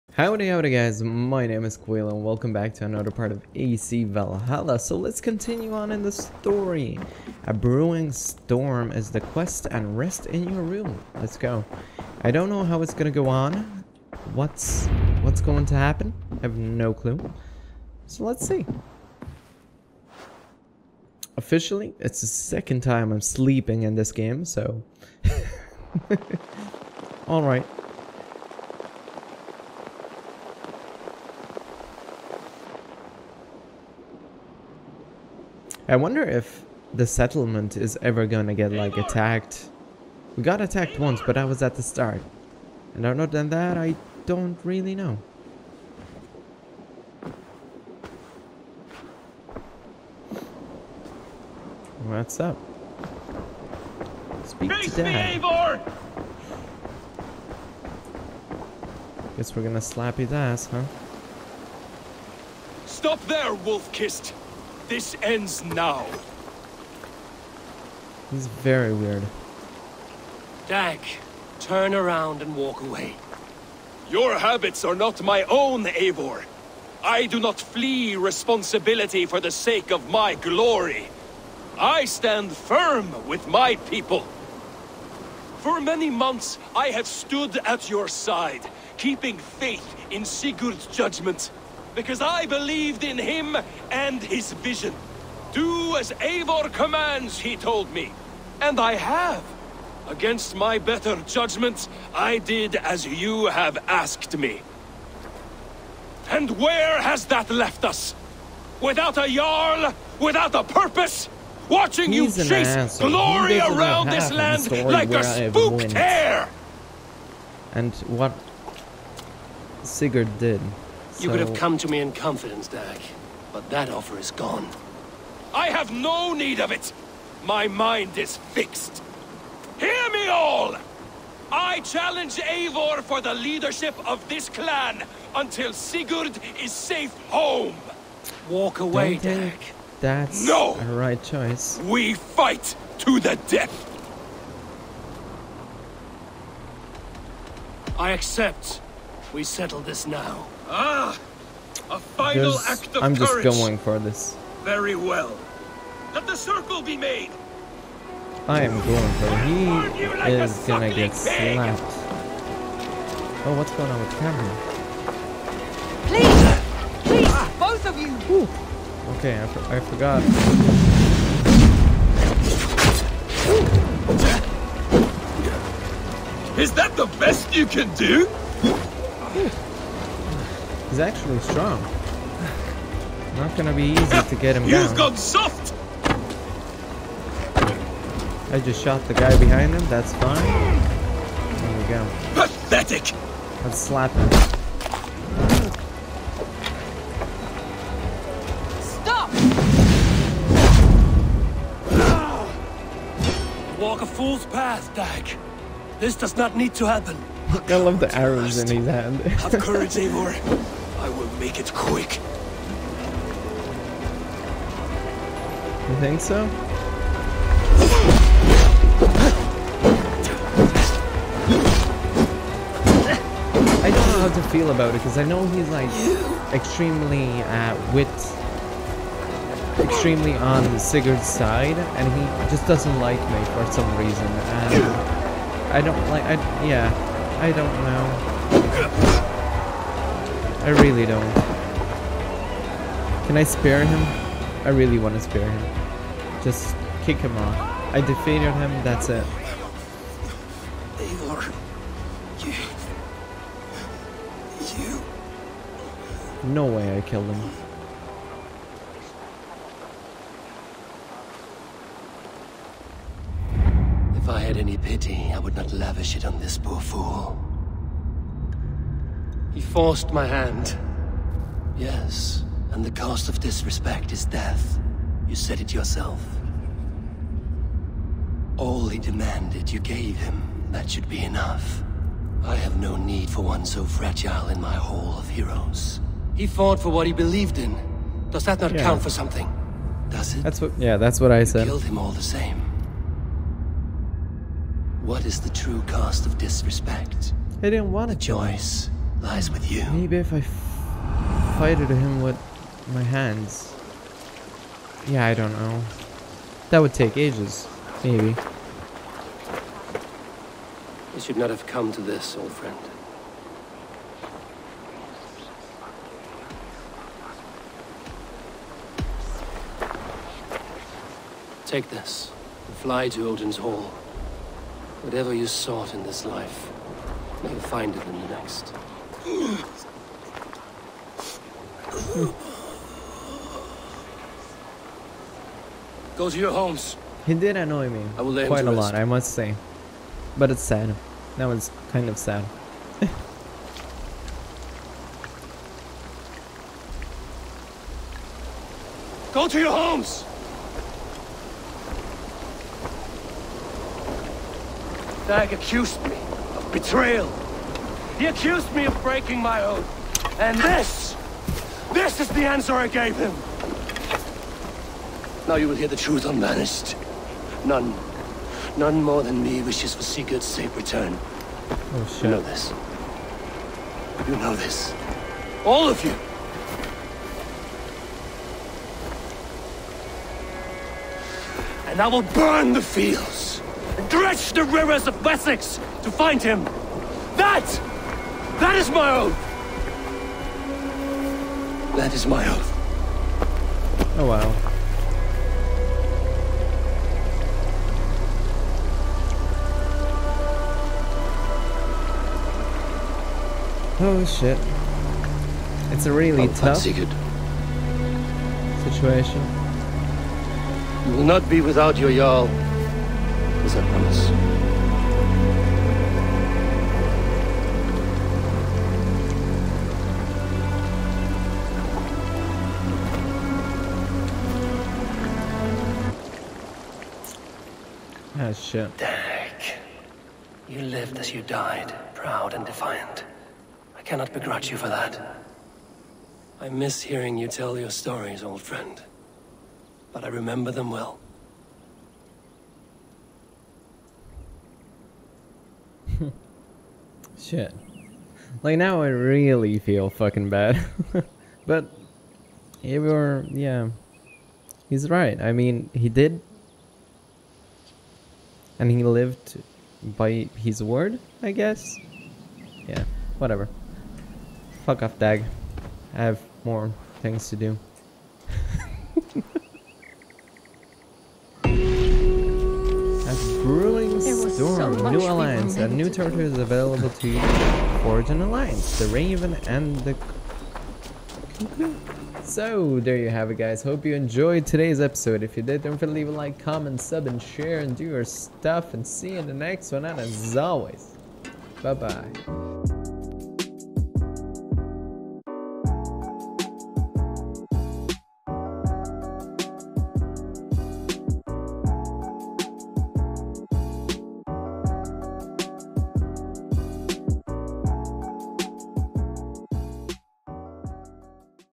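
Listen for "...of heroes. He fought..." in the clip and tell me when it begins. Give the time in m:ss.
4:45.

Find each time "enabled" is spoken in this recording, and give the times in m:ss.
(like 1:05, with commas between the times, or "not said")
not said.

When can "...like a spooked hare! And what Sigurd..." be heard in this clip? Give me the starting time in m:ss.
1:54.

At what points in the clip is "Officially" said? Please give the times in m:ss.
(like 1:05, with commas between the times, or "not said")
0:21.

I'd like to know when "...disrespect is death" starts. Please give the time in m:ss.
4:33.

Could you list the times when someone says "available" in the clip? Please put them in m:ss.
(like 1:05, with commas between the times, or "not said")
7:56.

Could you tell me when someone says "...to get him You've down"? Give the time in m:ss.
3:04.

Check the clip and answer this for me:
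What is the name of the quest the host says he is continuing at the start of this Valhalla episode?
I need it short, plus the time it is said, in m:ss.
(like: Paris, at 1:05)
A Brewing Storm, at 0:07.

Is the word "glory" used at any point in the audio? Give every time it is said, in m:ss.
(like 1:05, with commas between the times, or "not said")
1:20, 1:52.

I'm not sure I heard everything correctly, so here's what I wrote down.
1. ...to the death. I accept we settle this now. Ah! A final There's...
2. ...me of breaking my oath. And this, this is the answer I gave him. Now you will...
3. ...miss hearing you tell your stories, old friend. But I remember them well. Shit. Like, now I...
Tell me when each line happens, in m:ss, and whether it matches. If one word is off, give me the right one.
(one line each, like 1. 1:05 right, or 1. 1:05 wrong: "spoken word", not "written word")
1. 2:22 right
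2. 5:58 right
3. 7:16 right.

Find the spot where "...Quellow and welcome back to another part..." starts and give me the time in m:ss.
0:01.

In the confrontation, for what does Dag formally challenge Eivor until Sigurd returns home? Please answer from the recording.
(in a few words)
leadership of this clan.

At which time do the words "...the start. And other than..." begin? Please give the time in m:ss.
0:41.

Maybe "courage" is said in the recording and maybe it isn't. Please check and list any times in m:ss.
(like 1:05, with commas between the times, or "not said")
2:33, 3:29.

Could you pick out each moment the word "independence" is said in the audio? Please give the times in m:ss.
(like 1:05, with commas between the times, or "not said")
not said.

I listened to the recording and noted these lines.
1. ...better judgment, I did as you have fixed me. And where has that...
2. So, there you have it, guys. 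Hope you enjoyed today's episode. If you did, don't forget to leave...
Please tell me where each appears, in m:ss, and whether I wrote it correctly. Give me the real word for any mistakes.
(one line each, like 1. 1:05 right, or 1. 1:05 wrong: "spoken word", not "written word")
1. 1:40 wrong: "asked", not "fixed"
2. 8:02 right.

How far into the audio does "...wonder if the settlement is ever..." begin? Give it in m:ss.
0:35.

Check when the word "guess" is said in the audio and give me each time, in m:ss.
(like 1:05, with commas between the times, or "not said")
0:59, 7:41.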